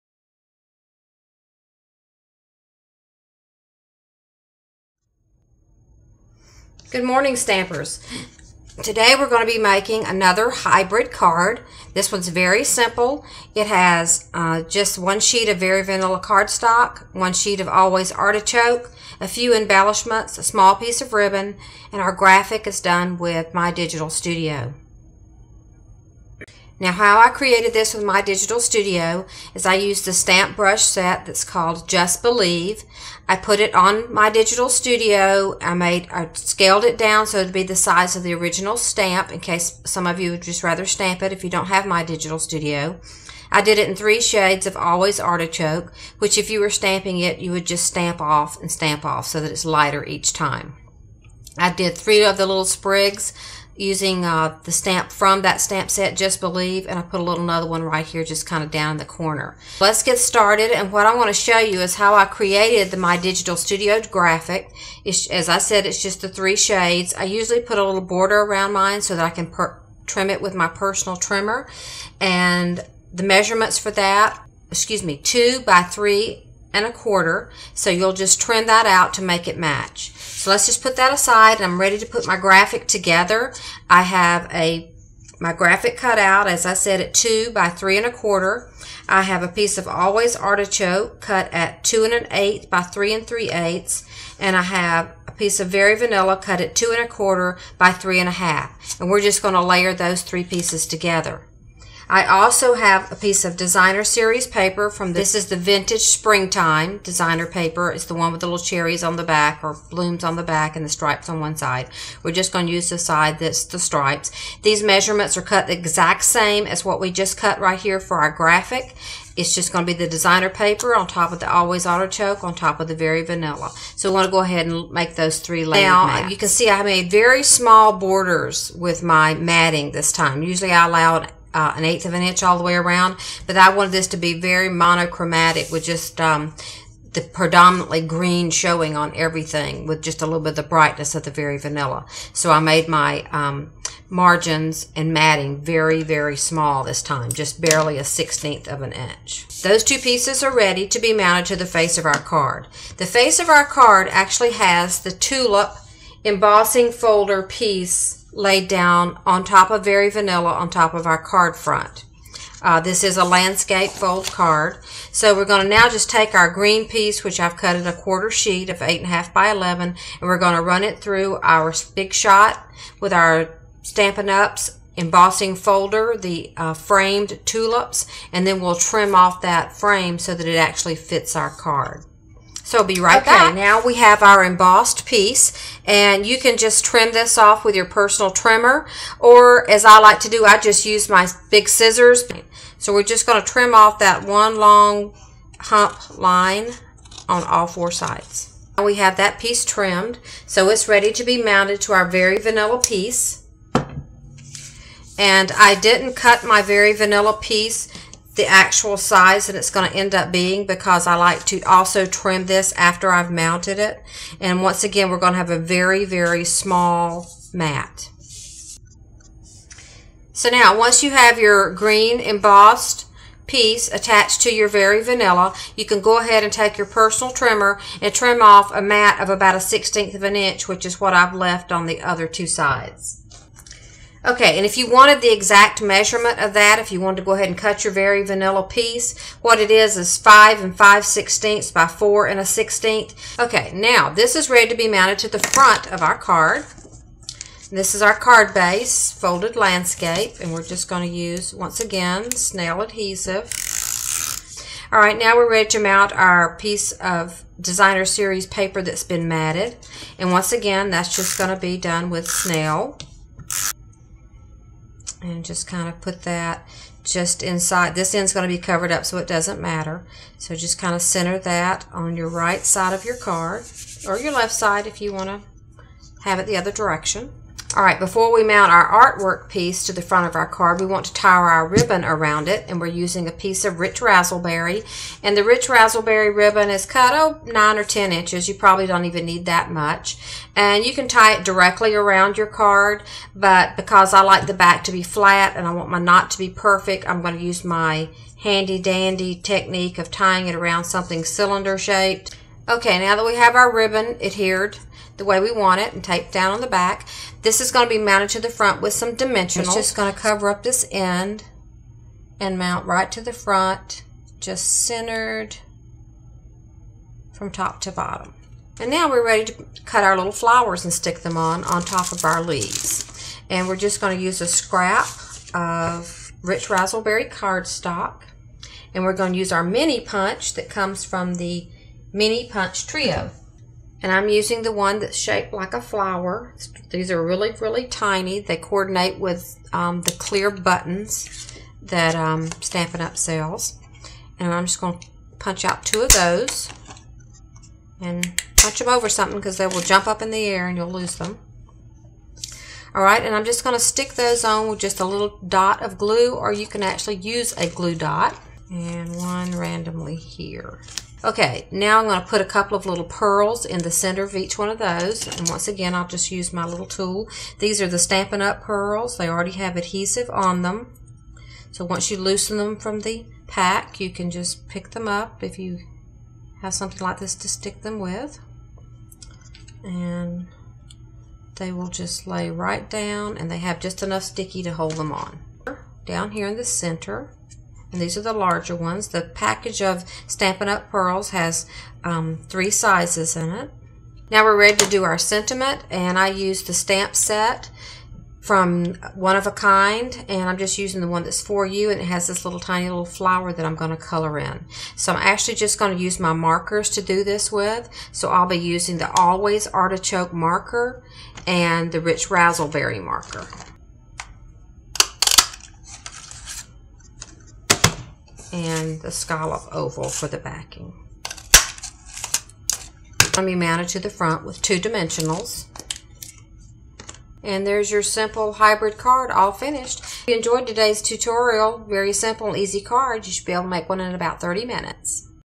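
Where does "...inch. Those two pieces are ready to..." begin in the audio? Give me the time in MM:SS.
02:28.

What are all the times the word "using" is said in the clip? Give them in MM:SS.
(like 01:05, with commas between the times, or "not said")
00:53, 04:42, 05:34, 06:40, 06:48.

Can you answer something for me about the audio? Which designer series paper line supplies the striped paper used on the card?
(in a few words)
Vintage Springtime.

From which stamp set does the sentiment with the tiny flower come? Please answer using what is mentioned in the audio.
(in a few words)
One of a Kind.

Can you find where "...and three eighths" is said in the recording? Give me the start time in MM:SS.
01:33.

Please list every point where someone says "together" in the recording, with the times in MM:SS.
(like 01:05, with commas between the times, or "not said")
01:22, 01:40.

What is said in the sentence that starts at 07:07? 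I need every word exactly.
And there's your simple hybrid card all finished.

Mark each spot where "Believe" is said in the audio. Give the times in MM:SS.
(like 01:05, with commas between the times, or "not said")
00:32, 00:56.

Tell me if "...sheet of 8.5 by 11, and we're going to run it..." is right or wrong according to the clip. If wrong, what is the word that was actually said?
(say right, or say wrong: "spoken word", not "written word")
right.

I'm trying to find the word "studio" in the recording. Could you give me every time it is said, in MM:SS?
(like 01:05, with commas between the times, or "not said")
00:24, 00:28, 00:34, 00:42, 01:03.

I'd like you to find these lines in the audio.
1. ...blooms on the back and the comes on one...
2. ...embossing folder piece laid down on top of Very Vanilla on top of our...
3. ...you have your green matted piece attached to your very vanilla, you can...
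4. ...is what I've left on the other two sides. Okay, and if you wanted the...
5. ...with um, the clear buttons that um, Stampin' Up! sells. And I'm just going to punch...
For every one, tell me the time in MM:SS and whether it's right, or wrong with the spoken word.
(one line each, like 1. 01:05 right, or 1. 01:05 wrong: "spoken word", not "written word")
1. 01:49 wrong: "stripes", not "comes"
2. 02:36 right
3. 03:41 wrong: "embossed", not "matted"
4. 03:50 right
5. 05:39 right.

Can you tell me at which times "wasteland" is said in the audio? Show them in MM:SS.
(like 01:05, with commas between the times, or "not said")
not said.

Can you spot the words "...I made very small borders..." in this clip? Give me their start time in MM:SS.
02:06.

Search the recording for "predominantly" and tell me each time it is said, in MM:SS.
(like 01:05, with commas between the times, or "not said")
02:17.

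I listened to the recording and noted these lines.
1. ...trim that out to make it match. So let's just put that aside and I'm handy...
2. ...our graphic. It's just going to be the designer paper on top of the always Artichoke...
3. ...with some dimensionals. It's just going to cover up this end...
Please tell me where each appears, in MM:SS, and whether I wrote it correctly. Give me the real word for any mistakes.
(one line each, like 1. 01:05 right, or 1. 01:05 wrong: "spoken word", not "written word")
1. 01:18 wrong: "ready", not "handy"
2. 01:58 right
3. 05:08 right.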